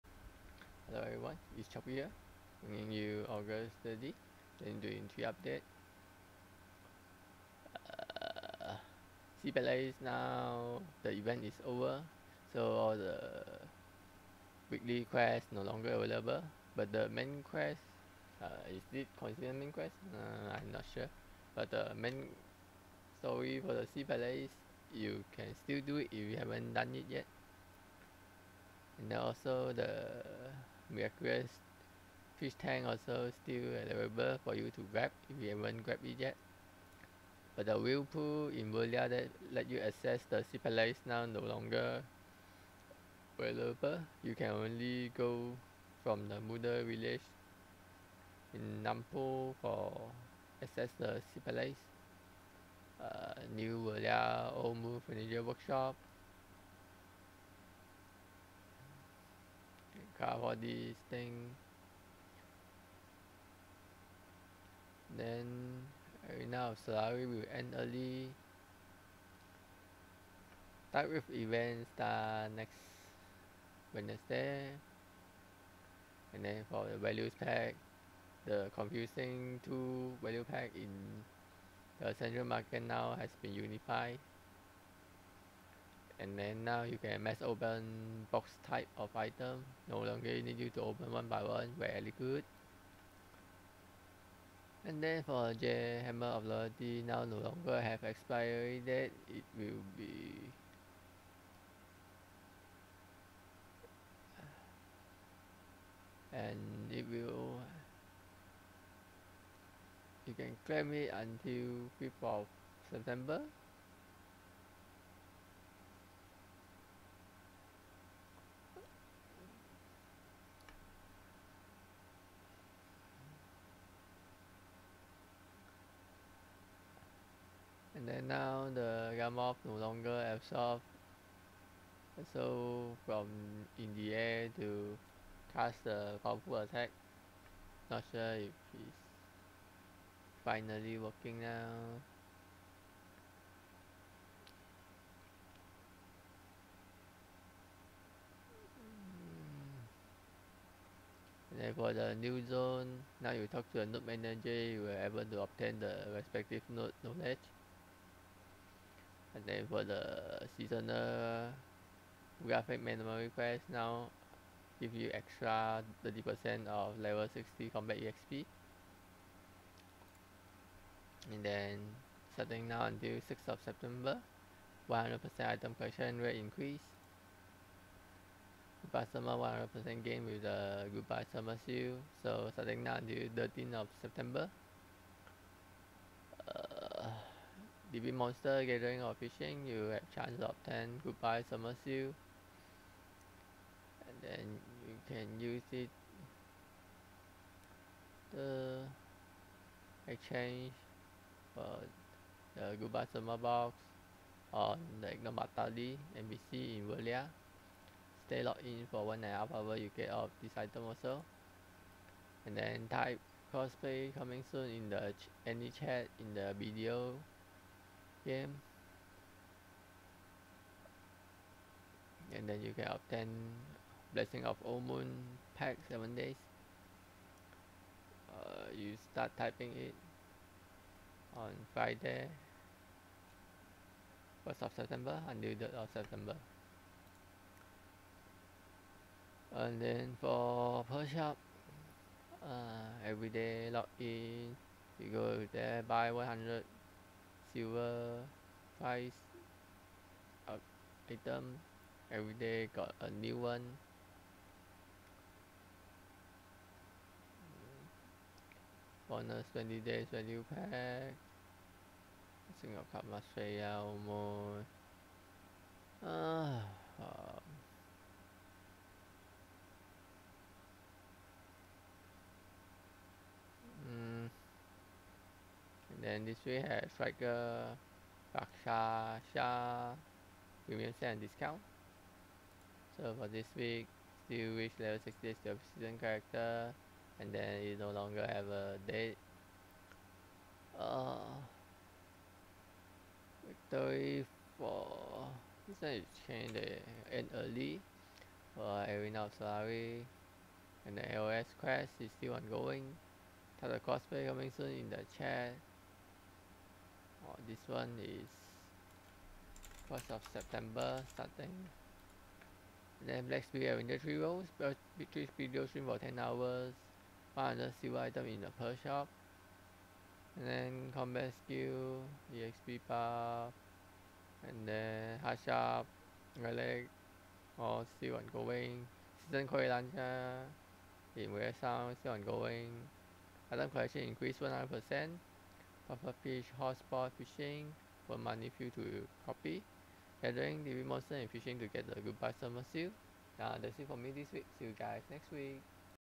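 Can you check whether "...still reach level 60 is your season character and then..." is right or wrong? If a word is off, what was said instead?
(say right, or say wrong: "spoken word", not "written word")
right.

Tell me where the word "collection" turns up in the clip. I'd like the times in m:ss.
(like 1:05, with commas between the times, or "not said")
2:55, 5:33.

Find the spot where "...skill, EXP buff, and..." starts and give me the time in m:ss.
5:21.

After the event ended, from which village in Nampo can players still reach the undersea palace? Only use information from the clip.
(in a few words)
Muda village.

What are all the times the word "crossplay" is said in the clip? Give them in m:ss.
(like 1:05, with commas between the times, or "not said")
3:33, 5:03.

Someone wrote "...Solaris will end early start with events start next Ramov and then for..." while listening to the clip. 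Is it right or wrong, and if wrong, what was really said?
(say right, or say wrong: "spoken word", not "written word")
wrong: "Wednesday", not "Ramov".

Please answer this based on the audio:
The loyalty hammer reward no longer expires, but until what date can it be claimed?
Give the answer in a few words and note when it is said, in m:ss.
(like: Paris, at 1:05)
5th of September, at 1:51.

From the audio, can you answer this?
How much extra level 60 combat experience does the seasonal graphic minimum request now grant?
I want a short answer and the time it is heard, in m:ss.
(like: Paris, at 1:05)
30%, at 2:45.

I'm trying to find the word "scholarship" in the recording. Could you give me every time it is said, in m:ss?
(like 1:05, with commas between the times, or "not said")
not said.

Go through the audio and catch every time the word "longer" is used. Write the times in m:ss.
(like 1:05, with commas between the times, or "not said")
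0:15, 0:41, 1:29, 1:37, 2:09, 4:47.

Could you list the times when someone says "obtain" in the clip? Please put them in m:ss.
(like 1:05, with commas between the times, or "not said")
2:35, 3:42.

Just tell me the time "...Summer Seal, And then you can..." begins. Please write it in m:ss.
3:11.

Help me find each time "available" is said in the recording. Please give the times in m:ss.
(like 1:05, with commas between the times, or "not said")
0:15, 0:33, 0:43.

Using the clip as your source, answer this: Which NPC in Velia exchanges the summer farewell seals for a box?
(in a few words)
Ignomatali.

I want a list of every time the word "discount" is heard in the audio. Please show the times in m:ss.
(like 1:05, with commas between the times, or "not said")
4:41.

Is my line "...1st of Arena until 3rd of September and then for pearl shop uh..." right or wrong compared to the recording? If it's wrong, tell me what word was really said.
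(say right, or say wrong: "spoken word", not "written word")
wrong: "September", not "Arena".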